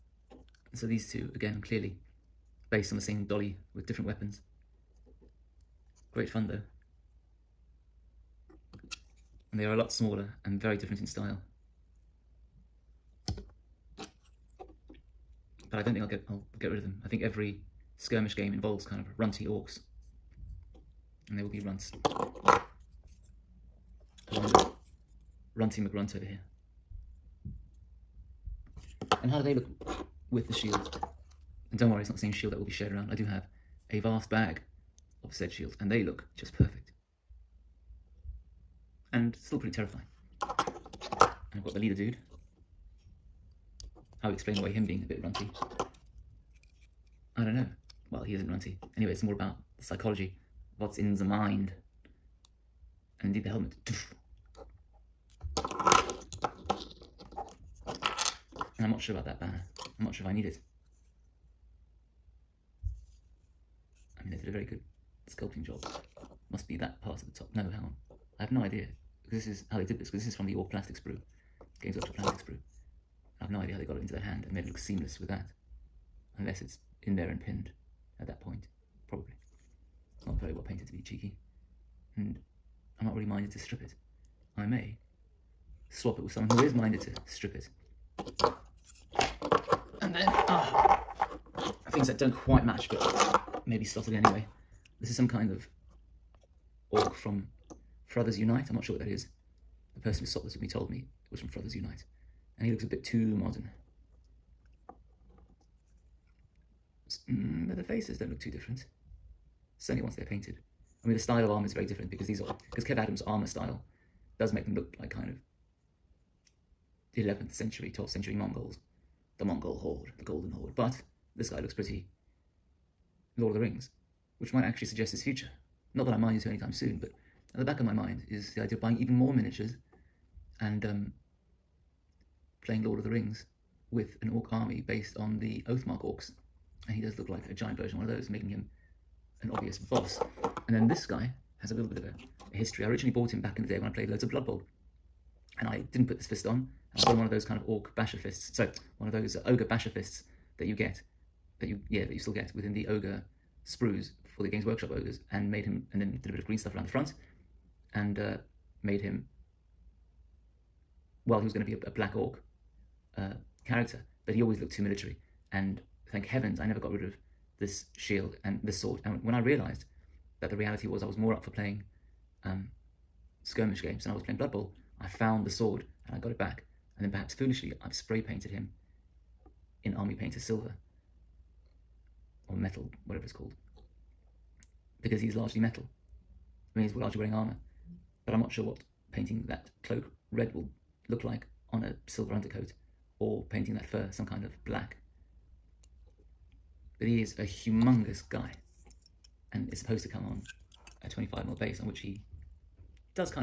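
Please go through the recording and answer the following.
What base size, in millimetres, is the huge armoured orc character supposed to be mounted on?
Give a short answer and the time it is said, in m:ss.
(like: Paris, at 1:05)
25mm, at 3:21.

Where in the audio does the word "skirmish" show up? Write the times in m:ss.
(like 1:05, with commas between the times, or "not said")
0:17, 2:53.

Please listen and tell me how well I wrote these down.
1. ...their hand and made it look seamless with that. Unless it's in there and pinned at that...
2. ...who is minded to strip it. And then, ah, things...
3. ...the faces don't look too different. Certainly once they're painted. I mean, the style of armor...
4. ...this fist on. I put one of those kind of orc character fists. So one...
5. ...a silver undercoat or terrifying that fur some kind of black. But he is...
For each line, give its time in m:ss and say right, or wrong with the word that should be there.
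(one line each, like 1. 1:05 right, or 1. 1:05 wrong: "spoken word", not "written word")
1. 1:14 right
2. 1:26 right
3. 1:47 right
4. 2:26 wrong: "basher", not "character"
5. 3:11 wrong: "painting", not "terrifying".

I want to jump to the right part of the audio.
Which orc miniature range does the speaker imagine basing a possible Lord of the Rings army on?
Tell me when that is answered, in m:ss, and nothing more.
2:15.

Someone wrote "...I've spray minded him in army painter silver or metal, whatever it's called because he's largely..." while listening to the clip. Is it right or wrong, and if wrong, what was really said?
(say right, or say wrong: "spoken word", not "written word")
wrong: "painted", not "minded".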